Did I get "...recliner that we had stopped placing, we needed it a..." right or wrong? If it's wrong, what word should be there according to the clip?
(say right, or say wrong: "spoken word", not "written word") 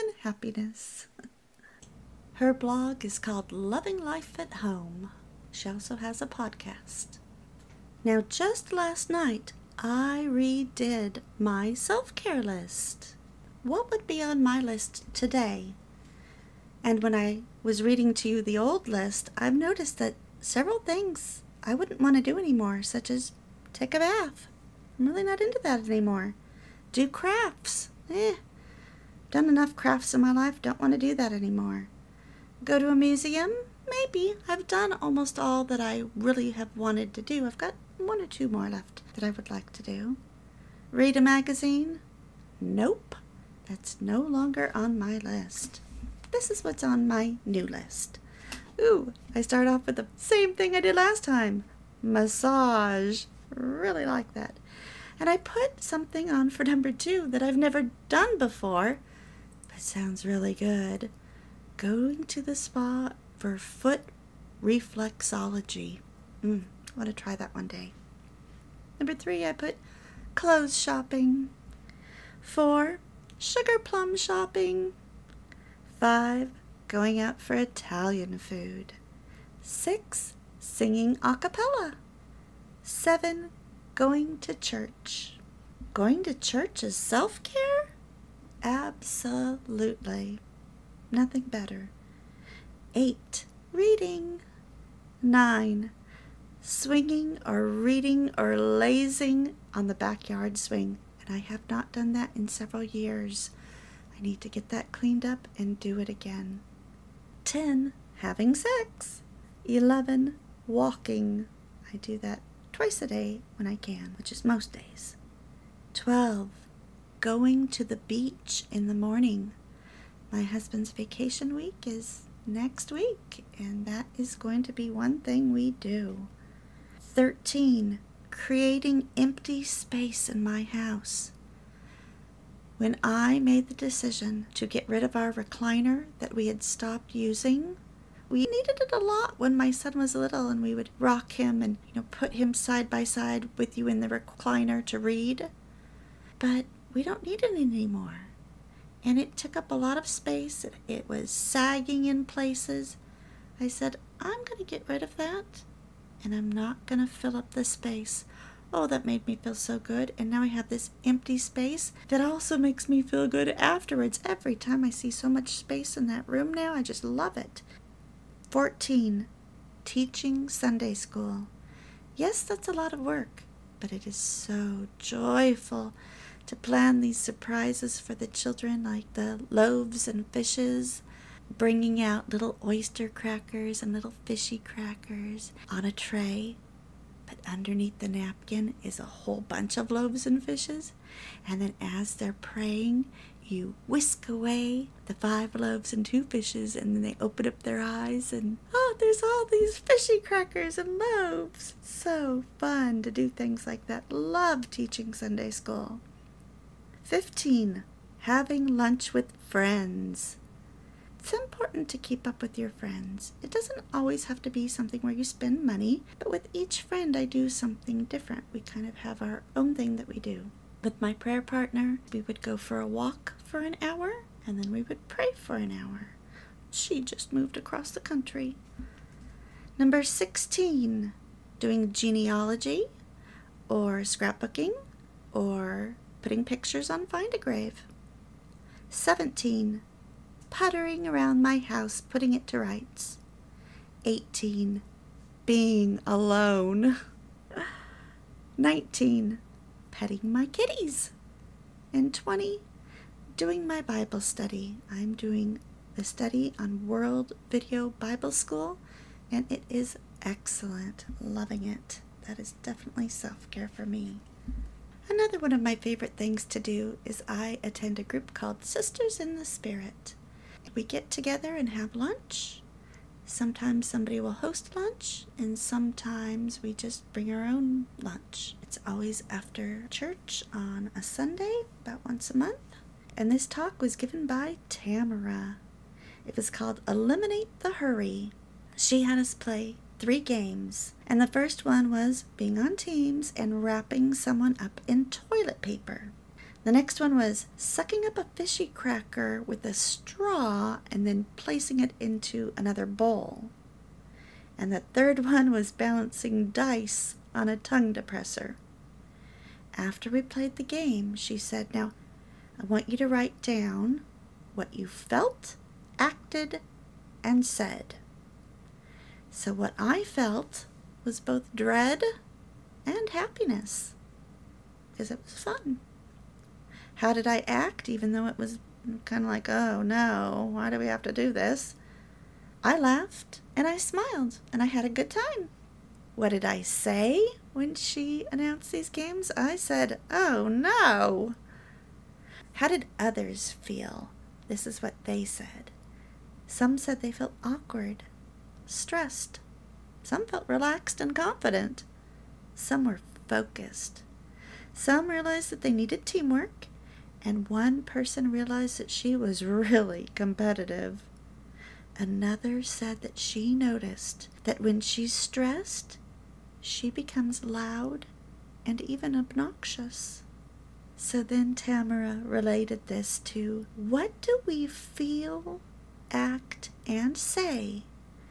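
wrong: "using", not "placing".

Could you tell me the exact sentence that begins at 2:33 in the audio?
I said, I'm going to get rid of that and I'm not going to fill up the space.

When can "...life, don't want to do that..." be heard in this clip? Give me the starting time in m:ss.
0:30.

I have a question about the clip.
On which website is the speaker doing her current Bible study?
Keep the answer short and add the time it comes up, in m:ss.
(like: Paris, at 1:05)
World Video Bible School, at 4:16.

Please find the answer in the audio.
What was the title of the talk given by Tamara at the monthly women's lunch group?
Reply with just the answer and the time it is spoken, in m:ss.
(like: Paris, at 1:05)
Eliminate the Hurry, at 4:46.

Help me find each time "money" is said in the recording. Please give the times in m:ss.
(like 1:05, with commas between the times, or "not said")
3:35.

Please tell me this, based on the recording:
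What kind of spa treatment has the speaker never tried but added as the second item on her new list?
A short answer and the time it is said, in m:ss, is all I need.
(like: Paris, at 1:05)
Foot reflexology, at 1:03.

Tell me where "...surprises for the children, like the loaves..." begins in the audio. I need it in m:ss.
2:57.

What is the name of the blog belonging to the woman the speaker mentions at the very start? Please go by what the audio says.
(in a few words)
Loving Life at Home.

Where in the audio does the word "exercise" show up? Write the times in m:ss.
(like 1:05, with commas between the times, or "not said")
not said.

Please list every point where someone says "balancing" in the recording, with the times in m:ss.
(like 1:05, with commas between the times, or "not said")
5:05.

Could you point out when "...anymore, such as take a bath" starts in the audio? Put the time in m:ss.
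0:22.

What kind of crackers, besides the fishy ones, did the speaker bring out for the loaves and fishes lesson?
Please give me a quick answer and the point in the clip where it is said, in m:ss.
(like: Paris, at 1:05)
Oyster crackers, at 3:02.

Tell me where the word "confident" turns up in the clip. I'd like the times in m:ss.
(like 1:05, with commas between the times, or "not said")
5:51.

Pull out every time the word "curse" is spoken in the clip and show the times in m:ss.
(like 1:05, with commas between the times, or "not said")
not said.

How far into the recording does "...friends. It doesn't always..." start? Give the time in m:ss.
3:32.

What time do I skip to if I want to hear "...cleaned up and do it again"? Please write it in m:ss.
1:44.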